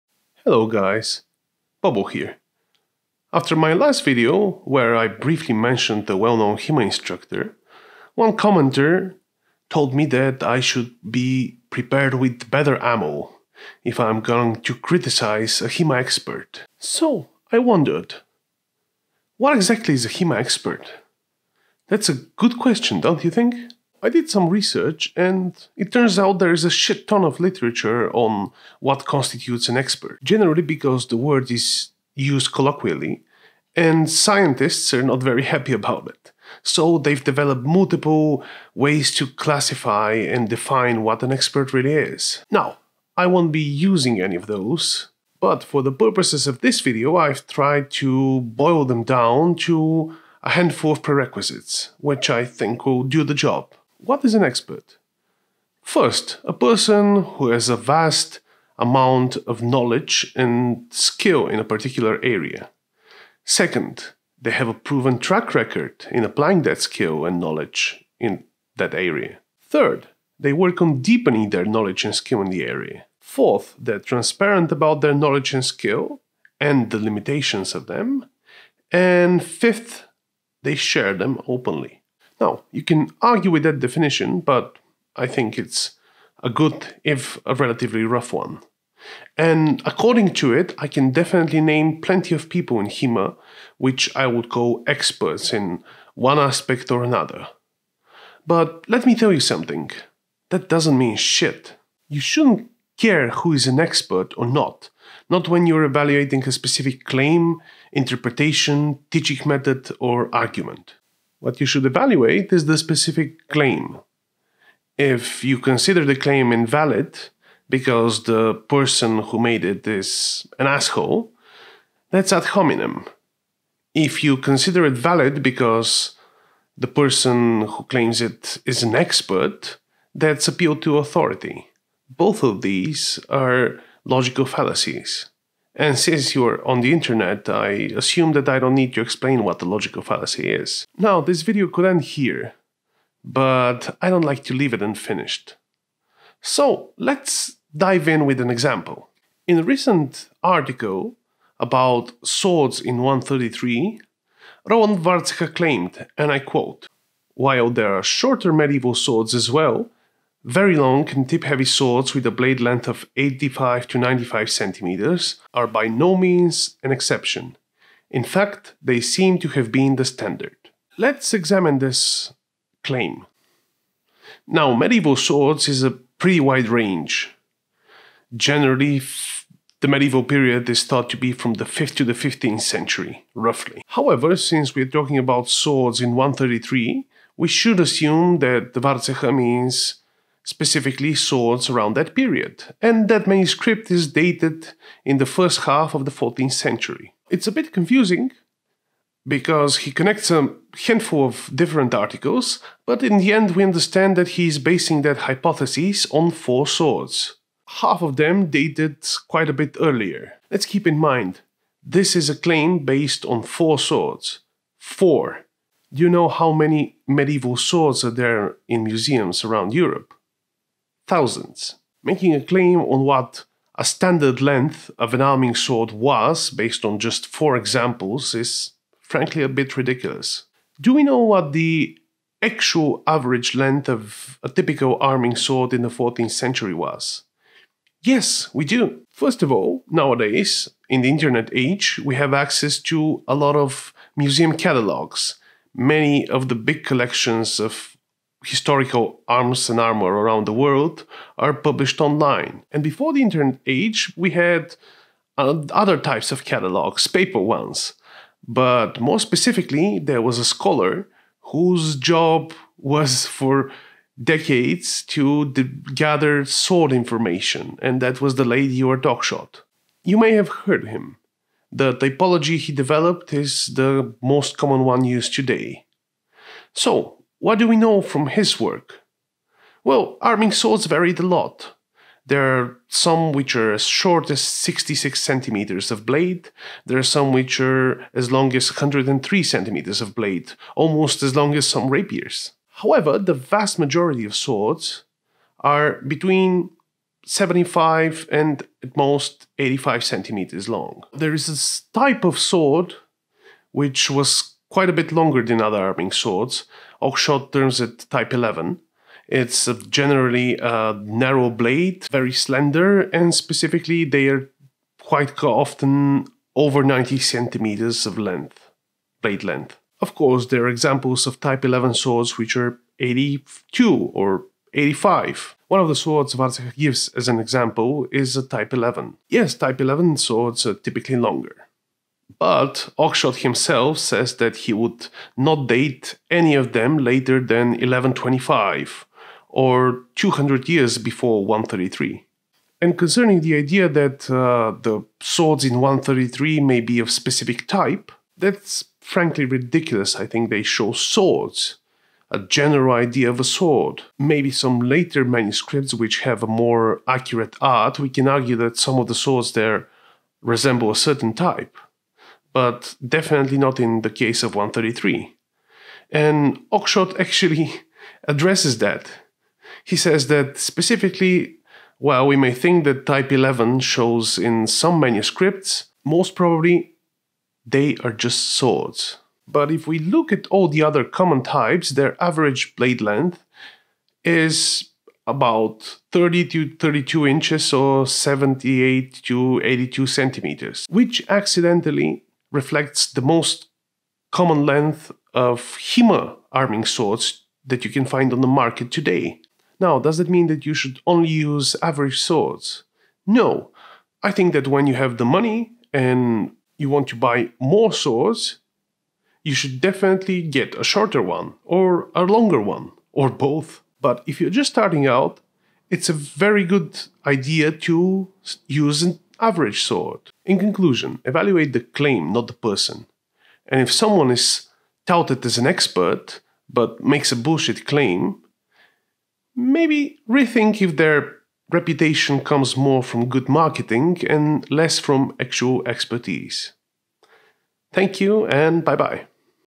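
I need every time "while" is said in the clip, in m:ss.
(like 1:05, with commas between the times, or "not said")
2:37, 6:11.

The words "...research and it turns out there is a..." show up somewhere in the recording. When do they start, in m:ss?
0:24.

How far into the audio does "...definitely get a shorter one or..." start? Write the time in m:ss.
6:49.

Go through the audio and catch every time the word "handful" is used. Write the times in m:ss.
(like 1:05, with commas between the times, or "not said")
0:50, 3:20.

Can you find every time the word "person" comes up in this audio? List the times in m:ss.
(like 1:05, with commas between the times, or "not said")
0:56, 1:58, 2:07, 7:02.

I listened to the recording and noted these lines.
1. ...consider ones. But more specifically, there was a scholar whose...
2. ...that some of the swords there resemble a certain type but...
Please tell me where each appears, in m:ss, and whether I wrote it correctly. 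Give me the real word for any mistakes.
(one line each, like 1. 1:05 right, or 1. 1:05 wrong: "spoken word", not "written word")
1. 4:17 wrong: "paper", not "consider"
2. 5:58 right.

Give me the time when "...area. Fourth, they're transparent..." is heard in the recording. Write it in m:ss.
1:12.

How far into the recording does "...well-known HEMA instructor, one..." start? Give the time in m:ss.
0:06.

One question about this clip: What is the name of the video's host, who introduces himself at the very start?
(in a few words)
Bobo.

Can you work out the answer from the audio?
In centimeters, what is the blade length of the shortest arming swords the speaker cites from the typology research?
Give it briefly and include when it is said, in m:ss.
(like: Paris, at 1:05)
66, at 4:44.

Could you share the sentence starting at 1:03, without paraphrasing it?
Second, they have a proven track record in applying that skill and knowledge in that area.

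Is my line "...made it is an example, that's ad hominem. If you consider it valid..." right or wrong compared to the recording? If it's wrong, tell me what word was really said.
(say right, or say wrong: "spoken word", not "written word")
wrong: "asshole", not "example".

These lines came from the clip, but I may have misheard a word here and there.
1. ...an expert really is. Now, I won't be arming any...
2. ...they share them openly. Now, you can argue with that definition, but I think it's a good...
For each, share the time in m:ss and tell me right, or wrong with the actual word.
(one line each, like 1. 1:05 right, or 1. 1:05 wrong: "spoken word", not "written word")
1. 0:41 wrong: "using", not "arming"
2. 1:20 right.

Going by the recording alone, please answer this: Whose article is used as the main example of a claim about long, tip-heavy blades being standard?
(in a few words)
Roland Warzecha.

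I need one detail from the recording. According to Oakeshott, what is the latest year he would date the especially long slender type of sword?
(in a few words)
1125.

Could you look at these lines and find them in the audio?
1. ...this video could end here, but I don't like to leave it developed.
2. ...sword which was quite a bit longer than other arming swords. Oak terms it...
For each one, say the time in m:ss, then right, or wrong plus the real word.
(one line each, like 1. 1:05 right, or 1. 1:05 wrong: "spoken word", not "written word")
1. 2:21 wrong: "unfinished", not "developed"
2. 5:02 right.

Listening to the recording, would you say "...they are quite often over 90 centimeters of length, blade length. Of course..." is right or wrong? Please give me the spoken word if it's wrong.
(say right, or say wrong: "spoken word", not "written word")
right.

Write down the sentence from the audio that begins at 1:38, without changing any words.
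But let me tell you something that doesn't mean shit.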